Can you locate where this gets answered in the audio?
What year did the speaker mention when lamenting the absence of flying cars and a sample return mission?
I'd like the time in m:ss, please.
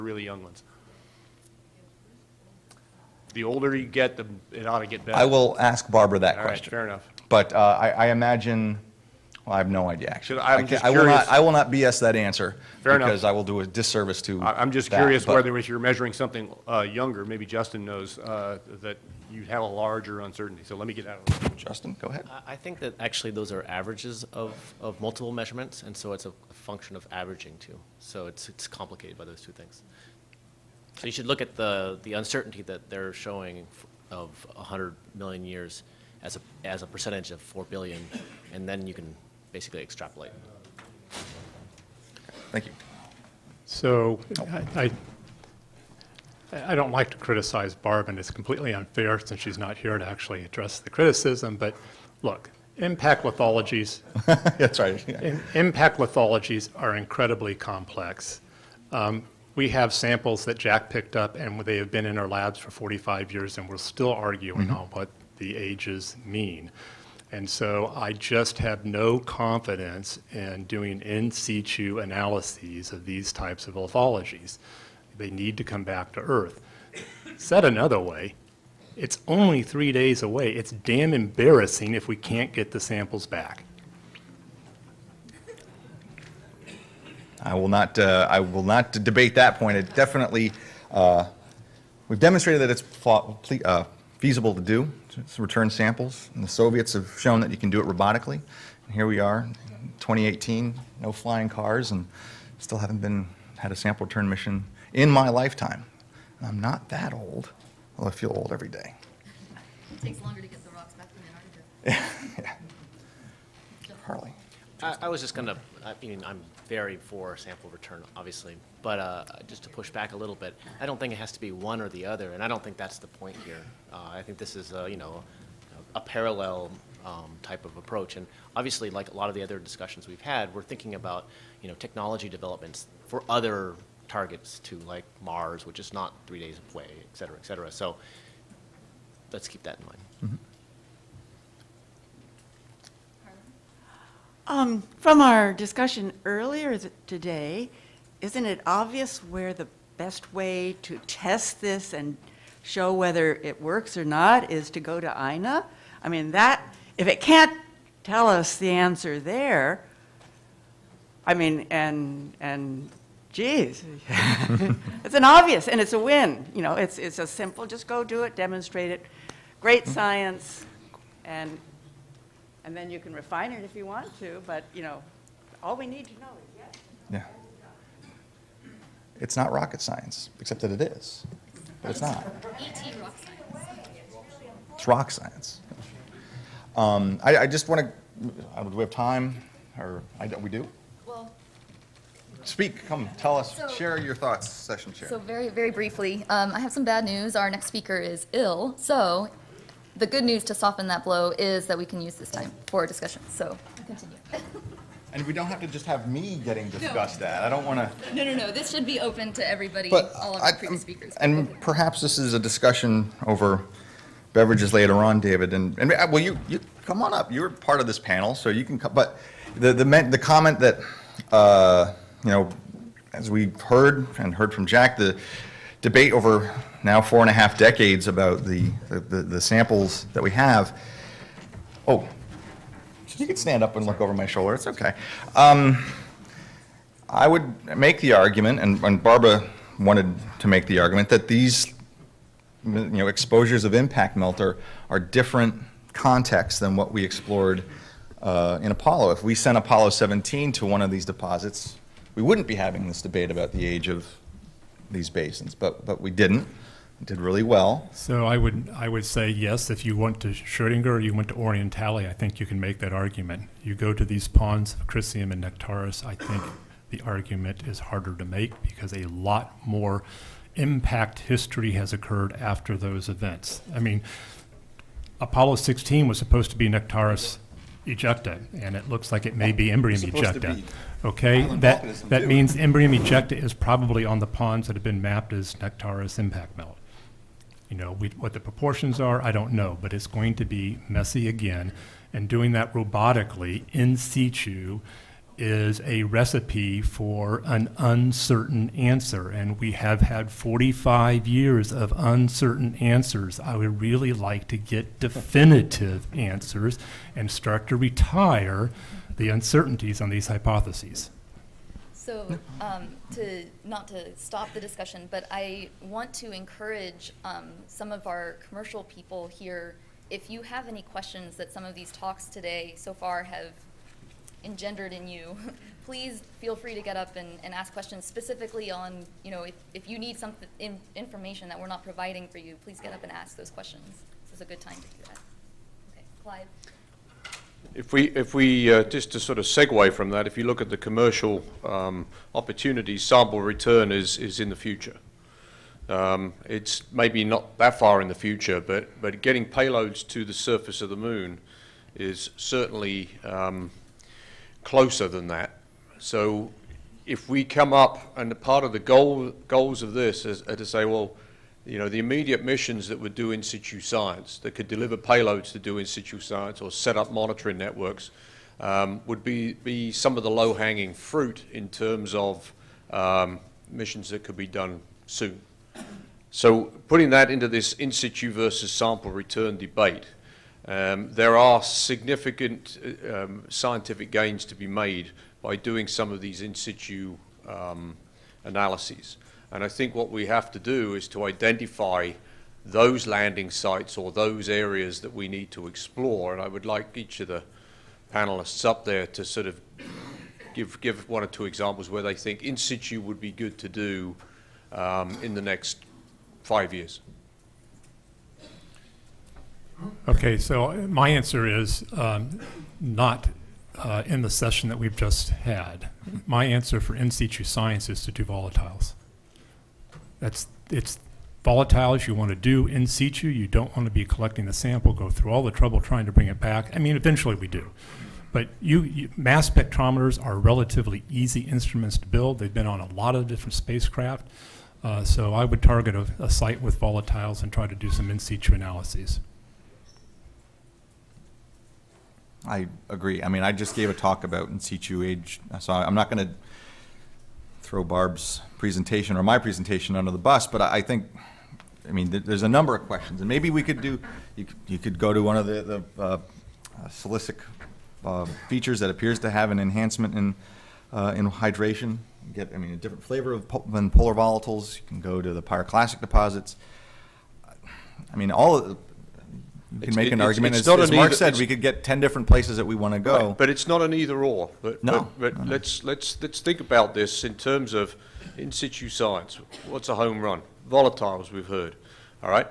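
1:39.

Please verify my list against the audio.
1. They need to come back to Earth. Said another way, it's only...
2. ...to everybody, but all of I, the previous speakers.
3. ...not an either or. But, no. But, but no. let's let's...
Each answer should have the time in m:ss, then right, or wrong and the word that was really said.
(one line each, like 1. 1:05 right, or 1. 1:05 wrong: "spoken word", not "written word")
1. 1:15 right
2. 3:29 right
3. 7:53 right.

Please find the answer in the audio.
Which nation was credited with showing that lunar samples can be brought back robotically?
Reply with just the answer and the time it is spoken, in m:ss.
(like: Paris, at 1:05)
The Soviets, at 1:36.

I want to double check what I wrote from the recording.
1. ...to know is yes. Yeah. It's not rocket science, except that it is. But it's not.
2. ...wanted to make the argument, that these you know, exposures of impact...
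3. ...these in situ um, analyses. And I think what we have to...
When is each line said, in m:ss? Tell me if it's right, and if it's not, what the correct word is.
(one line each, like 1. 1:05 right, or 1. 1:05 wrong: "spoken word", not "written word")
1. 2:56 right
2. 3:59 right
3. 6:26 right.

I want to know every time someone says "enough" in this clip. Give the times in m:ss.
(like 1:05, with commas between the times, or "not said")
0:06, 0:12.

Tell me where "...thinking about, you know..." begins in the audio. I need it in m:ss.
2:10.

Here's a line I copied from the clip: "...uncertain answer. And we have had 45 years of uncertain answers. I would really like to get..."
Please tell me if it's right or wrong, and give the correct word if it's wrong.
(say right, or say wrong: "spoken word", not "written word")
right.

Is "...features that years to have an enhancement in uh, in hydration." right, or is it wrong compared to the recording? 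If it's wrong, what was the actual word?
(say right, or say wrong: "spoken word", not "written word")
wrong: "appears", not "years".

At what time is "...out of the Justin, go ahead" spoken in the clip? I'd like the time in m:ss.
0:21.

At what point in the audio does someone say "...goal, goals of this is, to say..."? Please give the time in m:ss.
5:58.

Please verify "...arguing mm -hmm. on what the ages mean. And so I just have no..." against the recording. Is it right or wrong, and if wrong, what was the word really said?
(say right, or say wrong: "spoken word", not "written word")
right.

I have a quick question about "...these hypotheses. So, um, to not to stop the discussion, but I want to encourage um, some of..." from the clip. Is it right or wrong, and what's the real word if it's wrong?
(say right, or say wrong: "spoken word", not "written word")
right.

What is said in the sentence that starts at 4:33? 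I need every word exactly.
I mean, Apollo 16 was supposed to be Nectaris ejecta, and it looks like it may be Imbrium ejecta.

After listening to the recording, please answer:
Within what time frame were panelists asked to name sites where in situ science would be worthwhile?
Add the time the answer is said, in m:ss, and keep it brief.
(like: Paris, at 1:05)
Next five years, at 6:45.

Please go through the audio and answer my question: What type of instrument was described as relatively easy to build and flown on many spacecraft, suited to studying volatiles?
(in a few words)
Mass spectrometers.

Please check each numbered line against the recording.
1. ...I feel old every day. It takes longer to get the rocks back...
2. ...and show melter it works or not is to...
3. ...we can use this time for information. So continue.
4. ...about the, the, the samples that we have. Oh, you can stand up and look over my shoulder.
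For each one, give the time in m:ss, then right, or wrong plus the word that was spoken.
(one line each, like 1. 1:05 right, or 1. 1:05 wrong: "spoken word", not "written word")
1. 1:48 right
2. 2:31 wrong: "whether", not "melter"
3. 3:21 wrong: "discussion", not "information"
4. 3:48 right.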